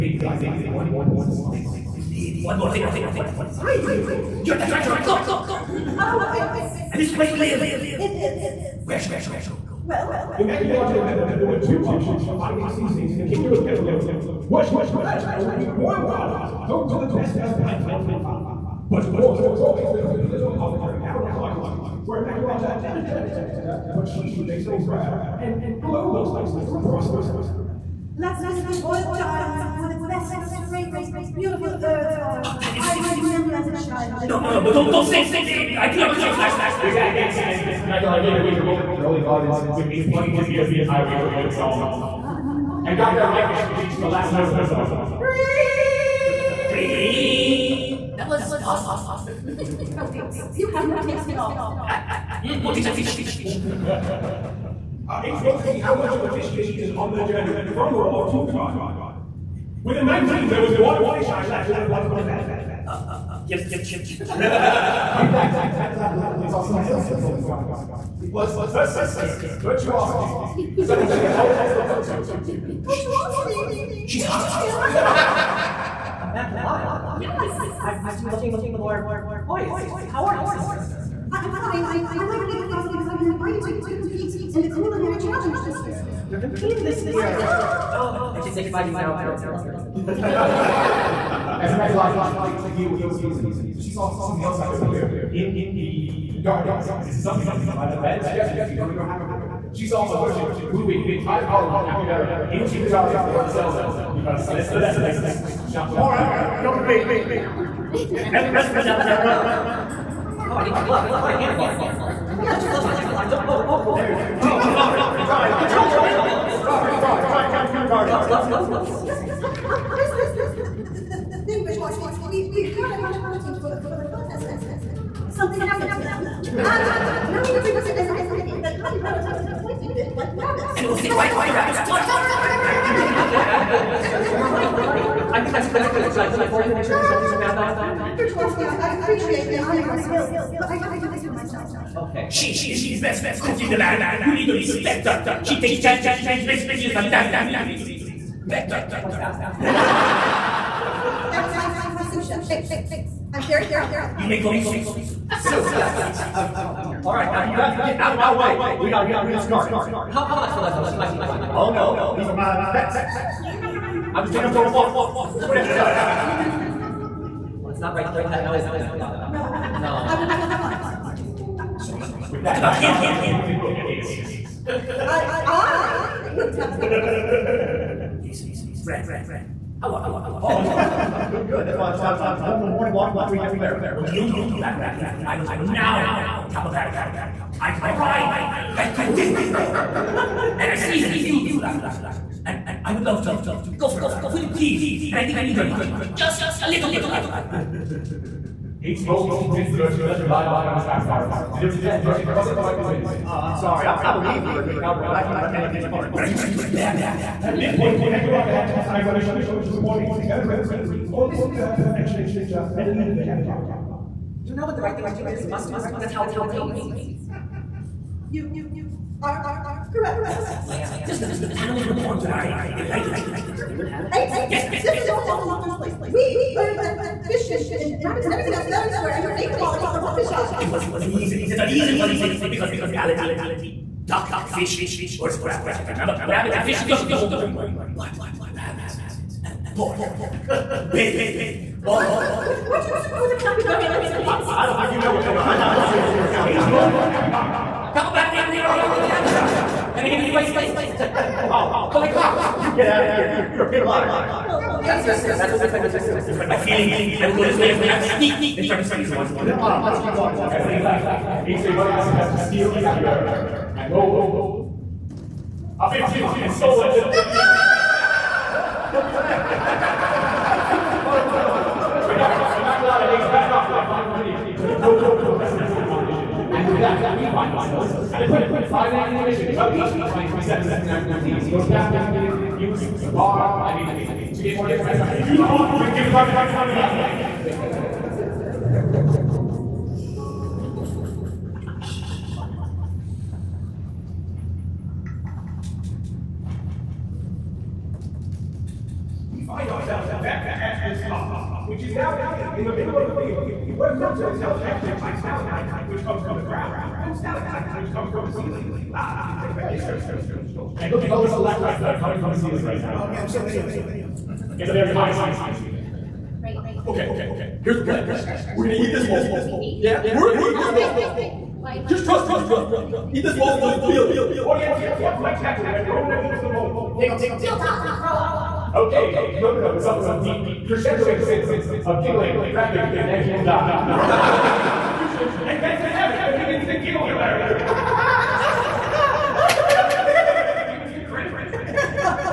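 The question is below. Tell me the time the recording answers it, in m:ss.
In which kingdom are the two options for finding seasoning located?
0:13.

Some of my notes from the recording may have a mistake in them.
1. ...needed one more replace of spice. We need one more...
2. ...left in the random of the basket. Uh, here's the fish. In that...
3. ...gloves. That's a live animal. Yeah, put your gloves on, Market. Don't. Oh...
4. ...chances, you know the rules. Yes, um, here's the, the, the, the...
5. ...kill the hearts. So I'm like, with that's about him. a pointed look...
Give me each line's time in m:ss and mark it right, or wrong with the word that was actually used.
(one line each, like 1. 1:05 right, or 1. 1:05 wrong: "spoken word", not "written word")
1. 0:00 wrong: "piece", not "replace"
2. 1:01 wrong: "bottom", not "random"
3. 1:50 wrong: "Capuline", not "Market"
4. 1:58 wrong: "gloves", not "chances"
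5. 2:50 right.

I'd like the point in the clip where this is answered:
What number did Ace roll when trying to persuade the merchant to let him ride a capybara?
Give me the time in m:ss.
3:21.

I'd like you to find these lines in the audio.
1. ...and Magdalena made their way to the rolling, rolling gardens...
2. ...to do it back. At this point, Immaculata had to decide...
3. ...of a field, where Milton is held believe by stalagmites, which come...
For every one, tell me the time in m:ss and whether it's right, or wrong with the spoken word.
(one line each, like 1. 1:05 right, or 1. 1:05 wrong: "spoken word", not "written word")
1. 0:37 right
2. 3:26 right
3. 5:02 wrong: "captive", not "believe".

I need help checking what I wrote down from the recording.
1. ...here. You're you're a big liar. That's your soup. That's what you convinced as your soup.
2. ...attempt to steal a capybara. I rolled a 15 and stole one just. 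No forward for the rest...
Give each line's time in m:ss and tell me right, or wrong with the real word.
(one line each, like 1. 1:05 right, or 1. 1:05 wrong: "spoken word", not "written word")
1. 4:13 wrong: "picked", not "convinced"
2. 4:22 right.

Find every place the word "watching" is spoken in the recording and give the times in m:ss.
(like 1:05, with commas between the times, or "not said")
3:15.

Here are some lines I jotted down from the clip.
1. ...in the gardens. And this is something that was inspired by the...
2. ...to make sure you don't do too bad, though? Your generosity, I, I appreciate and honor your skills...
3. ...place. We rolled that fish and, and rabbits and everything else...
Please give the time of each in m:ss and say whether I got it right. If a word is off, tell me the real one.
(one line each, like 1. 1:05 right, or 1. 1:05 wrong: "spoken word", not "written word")
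1. 1:35 right
2. 2:16 right
3. 3:45 wrong: "earned", not "rolled".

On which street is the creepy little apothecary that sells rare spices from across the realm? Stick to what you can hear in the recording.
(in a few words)
Market Street.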